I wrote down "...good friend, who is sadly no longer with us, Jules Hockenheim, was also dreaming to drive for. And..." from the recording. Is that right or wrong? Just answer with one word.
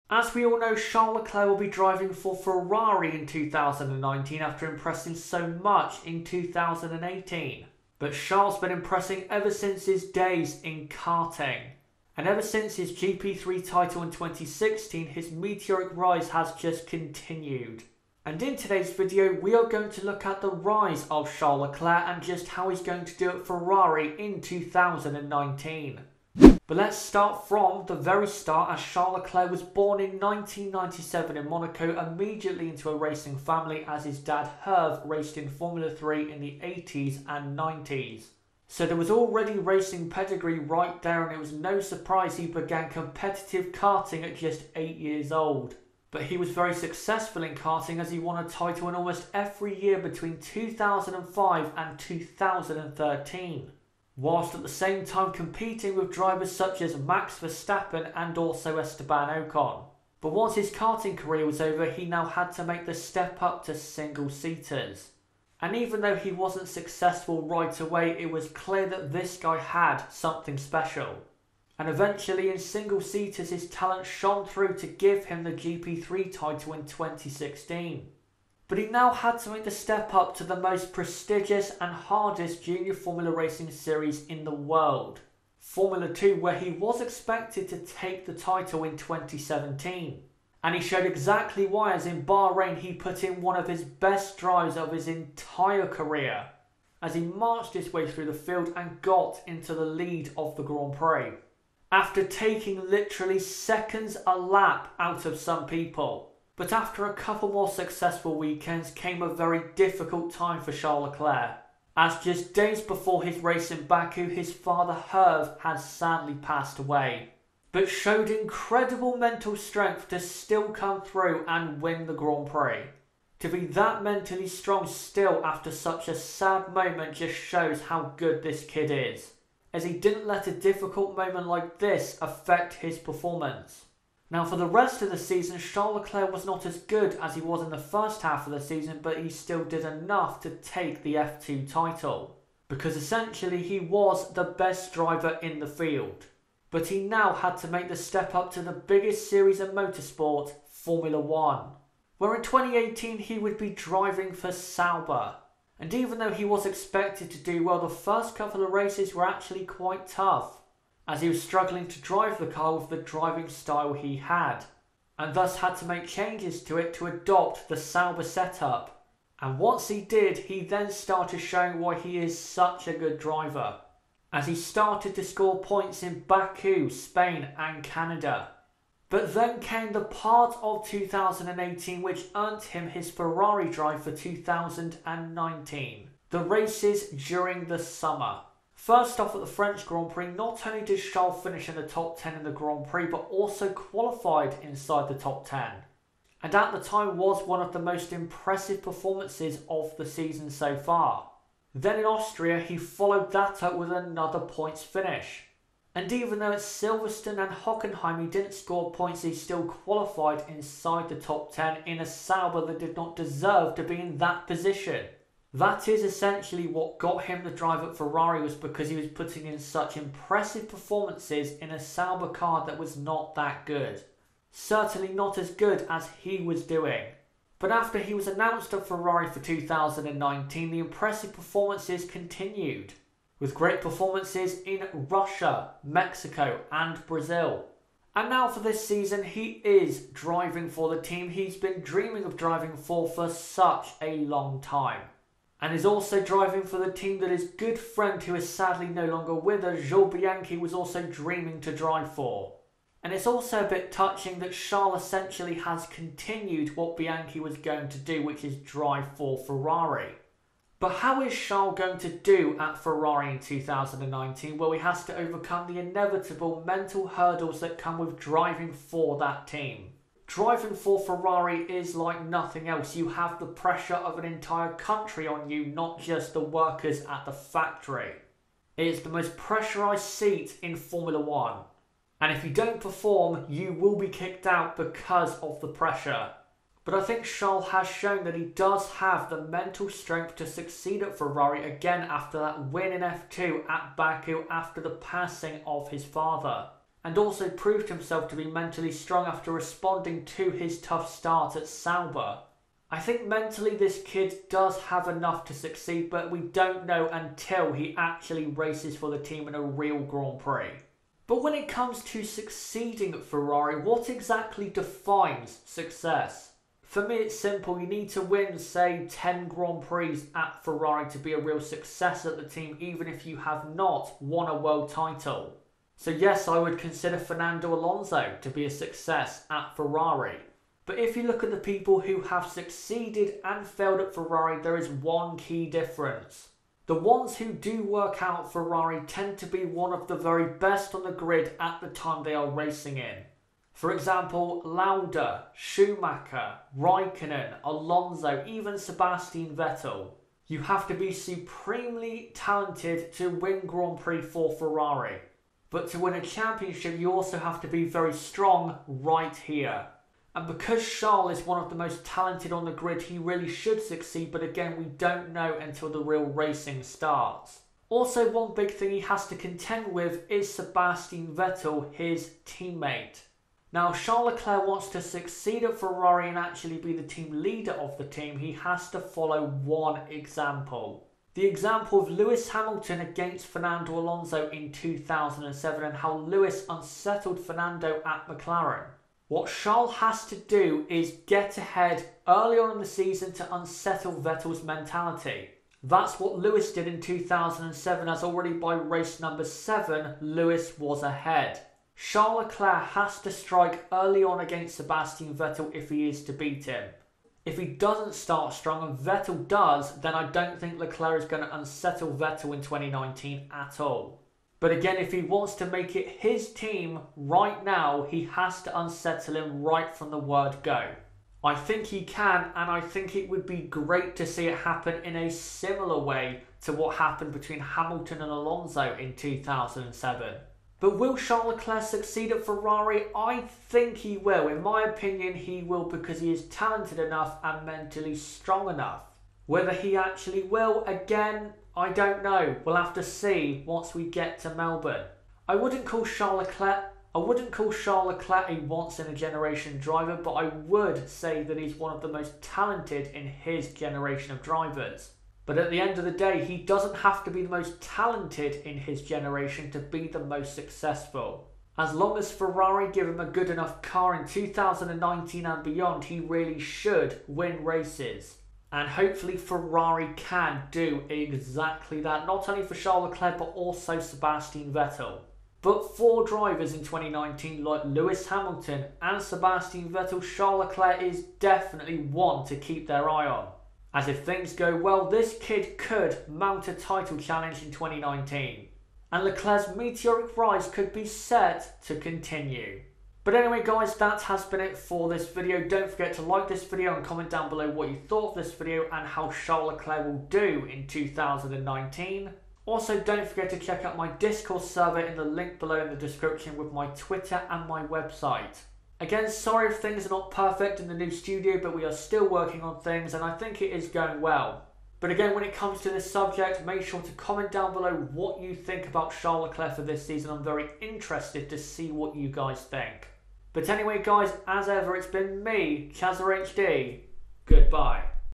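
wrong.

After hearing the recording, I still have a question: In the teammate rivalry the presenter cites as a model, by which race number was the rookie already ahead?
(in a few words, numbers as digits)
7.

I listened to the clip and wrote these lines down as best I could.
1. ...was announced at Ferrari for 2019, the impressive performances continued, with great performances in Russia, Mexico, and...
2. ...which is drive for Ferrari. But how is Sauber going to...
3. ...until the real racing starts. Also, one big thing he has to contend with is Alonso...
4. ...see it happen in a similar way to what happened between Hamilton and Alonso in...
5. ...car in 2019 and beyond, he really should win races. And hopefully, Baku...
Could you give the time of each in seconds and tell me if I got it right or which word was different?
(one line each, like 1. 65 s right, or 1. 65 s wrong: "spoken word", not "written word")
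1. 228 s right
2. 258 s wrong: "Charles", not "Sauber"
3. 365 s wrong: "Sebastian", not "Alonso"
4. 424 s right
5. 463 s wrong: "Ferrari", not "Baku".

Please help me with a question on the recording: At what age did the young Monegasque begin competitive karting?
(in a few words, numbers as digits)
8.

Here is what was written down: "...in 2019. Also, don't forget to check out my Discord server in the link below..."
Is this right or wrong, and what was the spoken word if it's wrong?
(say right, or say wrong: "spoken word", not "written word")
right.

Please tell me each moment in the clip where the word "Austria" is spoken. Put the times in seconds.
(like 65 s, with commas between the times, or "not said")
202 s.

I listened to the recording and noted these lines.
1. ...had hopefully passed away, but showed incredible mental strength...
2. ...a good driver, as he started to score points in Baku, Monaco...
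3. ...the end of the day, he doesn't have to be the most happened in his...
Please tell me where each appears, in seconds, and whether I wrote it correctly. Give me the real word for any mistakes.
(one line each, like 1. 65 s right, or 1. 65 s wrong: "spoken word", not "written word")
1. 115 s wrong: "sadly", not "hopefully"
2. 172 s wrong: "Spain", not "Monaco"
3. 455 s wrong: "talented", not "happened".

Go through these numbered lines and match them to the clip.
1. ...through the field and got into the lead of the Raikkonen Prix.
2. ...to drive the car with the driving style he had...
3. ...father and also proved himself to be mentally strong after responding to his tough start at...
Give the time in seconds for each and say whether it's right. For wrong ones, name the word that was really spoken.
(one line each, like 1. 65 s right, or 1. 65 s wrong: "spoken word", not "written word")
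1. 98 s wrong: "Grand", not "Raikkonen"
2. 161 s right
3. 296 s right.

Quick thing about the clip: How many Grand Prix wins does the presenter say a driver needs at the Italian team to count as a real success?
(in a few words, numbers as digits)
10.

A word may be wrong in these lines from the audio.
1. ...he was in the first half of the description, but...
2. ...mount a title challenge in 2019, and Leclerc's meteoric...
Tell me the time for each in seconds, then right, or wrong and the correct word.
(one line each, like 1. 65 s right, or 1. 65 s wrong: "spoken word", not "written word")
1. 137 s wrong: "season", not "description"
2. 486 s right.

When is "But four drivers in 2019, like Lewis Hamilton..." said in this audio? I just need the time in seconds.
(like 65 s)
475 s.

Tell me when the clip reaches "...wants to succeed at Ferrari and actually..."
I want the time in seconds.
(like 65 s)
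374 s.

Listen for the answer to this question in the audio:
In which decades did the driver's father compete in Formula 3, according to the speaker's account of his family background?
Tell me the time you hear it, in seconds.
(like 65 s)
36 s.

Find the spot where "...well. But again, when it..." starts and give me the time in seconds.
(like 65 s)
514 s.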